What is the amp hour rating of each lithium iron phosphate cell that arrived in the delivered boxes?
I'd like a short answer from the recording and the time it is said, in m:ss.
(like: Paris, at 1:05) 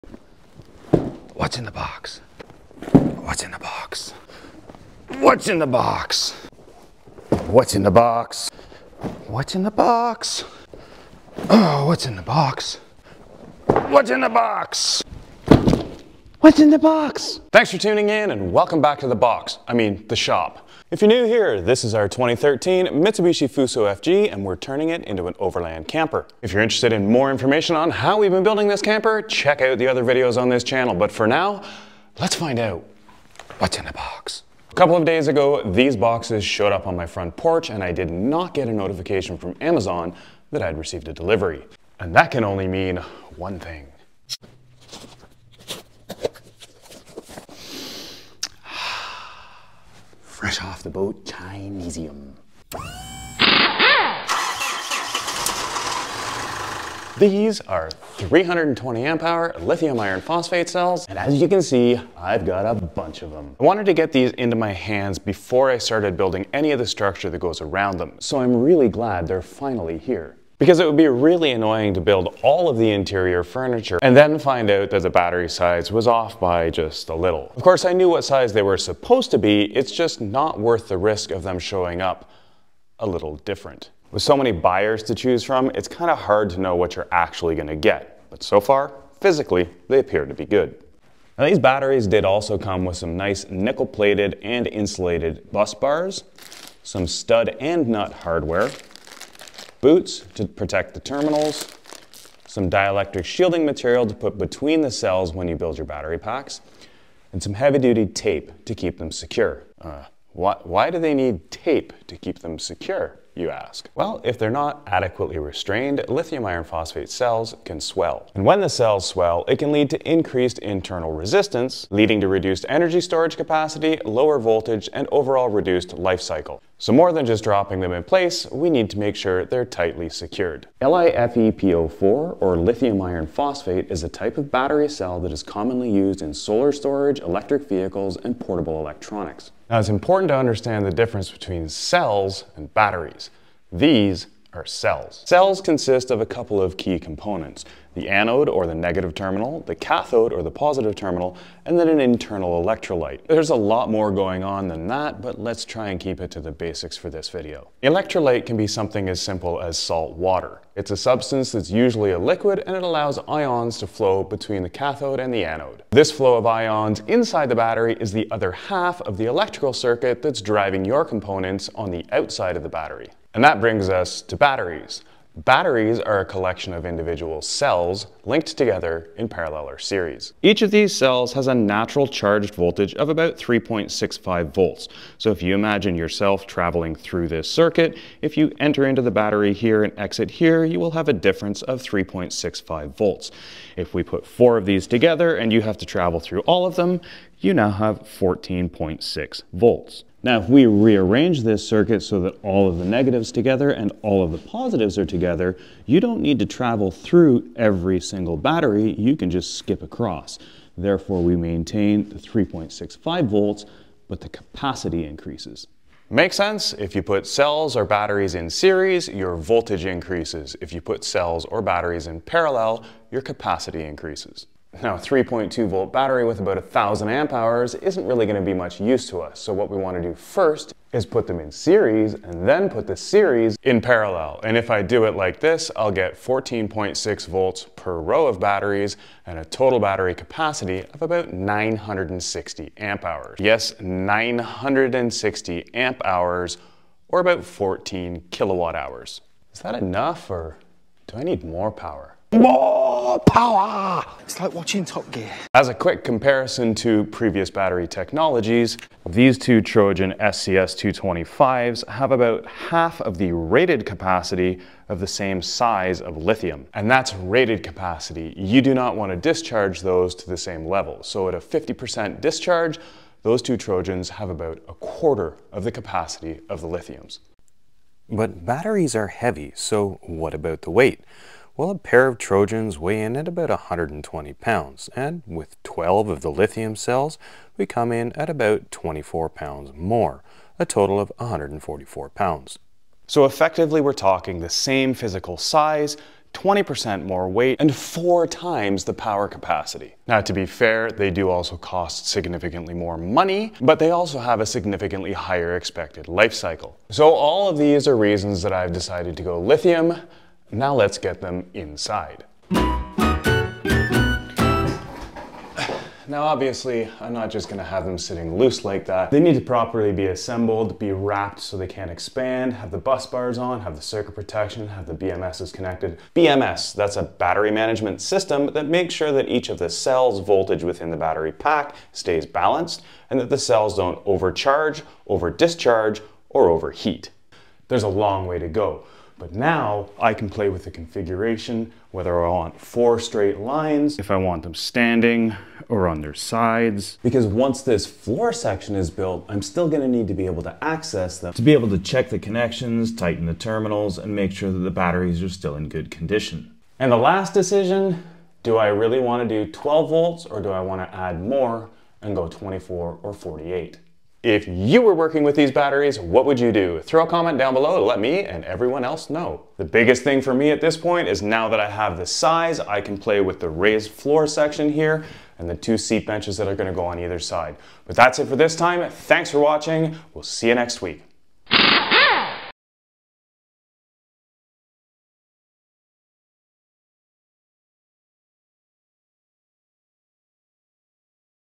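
320, at 0:58.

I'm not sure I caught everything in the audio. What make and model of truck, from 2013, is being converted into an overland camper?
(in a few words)
Mitsubishi Fuso FG.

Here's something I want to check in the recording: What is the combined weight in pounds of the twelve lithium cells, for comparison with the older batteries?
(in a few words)
144 pounds.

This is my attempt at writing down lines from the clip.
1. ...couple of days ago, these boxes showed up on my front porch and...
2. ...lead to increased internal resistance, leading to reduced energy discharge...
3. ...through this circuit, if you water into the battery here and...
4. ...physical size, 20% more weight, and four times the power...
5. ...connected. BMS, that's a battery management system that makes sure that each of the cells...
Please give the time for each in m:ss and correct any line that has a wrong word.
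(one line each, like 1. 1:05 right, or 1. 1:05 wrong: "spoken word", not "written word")
1. 0:34 right
2. 1:59 wrong: "storage", not "discharge"
3. 3:06 wrong: "enter", not "water"
4. 4:54 right
5. 5:25 right.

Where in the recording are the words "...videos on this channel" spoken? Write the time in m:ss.
0:30.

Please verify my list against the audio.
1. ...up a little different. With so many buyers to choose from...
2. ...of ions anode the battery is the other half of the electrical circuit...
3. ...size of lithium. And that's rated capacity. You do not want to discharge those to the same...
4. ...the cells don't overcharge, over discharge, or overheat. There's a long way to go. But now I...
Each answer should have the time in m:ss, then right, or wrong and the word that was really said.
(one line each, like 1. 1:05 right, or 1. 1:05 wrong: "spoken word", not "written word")
1. 1:21 right
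2. 2:46 wrong: "inside", not "anode"
3. 4:25 right
4. 5:33 right.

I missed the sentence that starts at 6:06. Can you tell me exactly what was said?
Throw a comment down below to let me and everyone else know.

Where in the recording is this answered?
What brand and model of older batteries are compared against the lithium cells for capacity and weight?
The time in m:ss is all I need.
4:19.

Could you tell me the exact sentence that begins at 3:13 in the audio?
If we put four of these together and you have to travel through all of them, you now have 14.6 volts.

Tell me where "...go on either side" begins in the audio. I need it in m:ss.
6:16.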